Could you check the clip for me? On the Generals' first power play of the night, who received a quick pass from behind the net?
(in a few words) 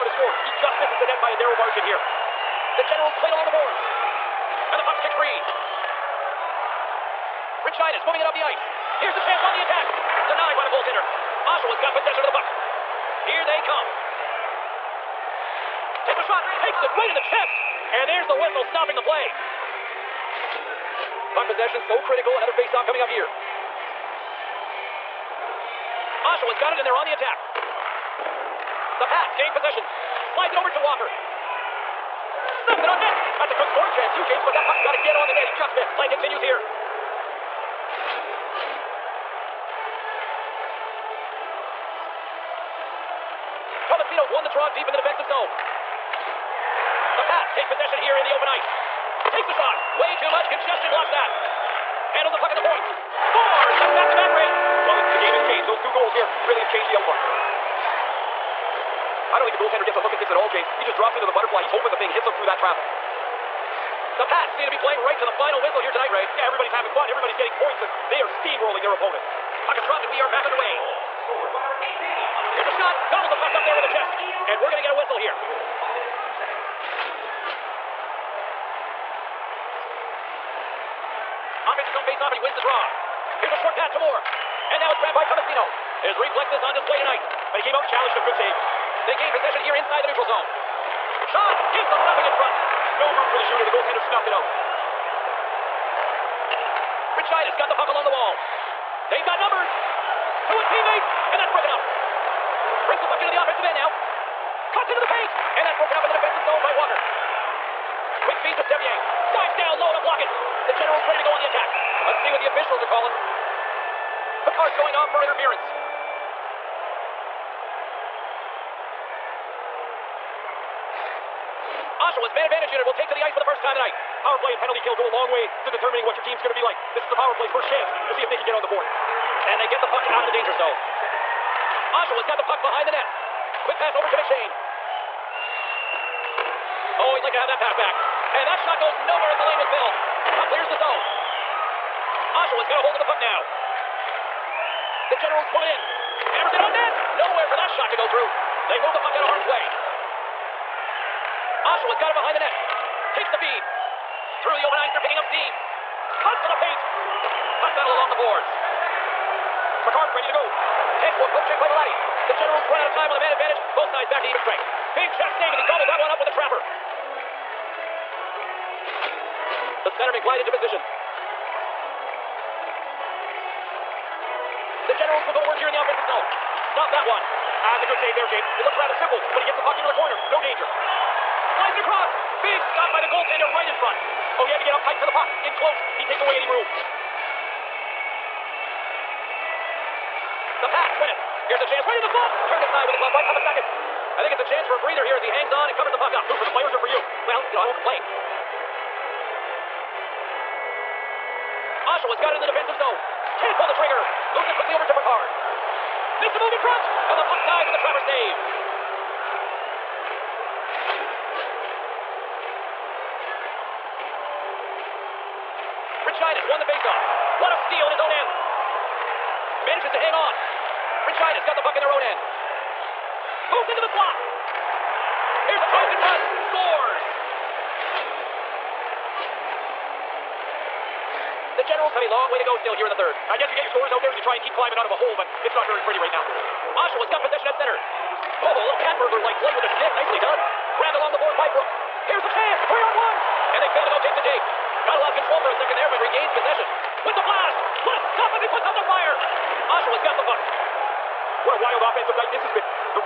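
McShane.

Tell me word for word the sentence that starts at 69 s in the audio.
Puck is dropped, and we are back underway.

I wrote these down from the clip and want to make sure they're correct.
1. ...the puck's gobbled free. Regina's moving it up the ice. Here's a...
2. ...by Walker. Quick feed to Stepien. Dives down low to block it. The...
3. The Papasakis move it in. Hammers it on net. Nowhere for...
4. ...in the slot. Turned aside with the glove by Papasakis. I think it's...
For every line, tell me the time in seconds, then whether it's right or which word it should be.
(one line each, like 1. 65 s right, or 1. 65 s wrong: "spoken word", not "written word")
1. 4 s wrong: "kicked", not "gobbled"
2. 106 s right
3. 145 s wrong: "Generals", not "Papasakis"
4. 191 s right.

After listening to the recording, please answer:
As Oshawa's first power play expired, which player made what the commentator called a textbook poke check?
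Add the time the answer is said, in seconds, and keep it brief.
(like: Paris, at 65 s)
Velati, at 161 s.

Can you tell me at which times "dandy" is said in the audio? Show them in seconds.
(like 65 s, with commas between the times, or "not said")
not said.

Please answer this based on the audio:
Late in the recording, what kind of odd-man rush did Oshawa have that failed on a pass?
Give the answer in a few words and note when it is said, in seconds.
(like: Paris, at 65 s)
Three on one, at 242 s.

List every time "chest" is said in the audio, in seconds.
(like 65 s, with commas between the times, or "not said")
17 s, 73 s, 165 s.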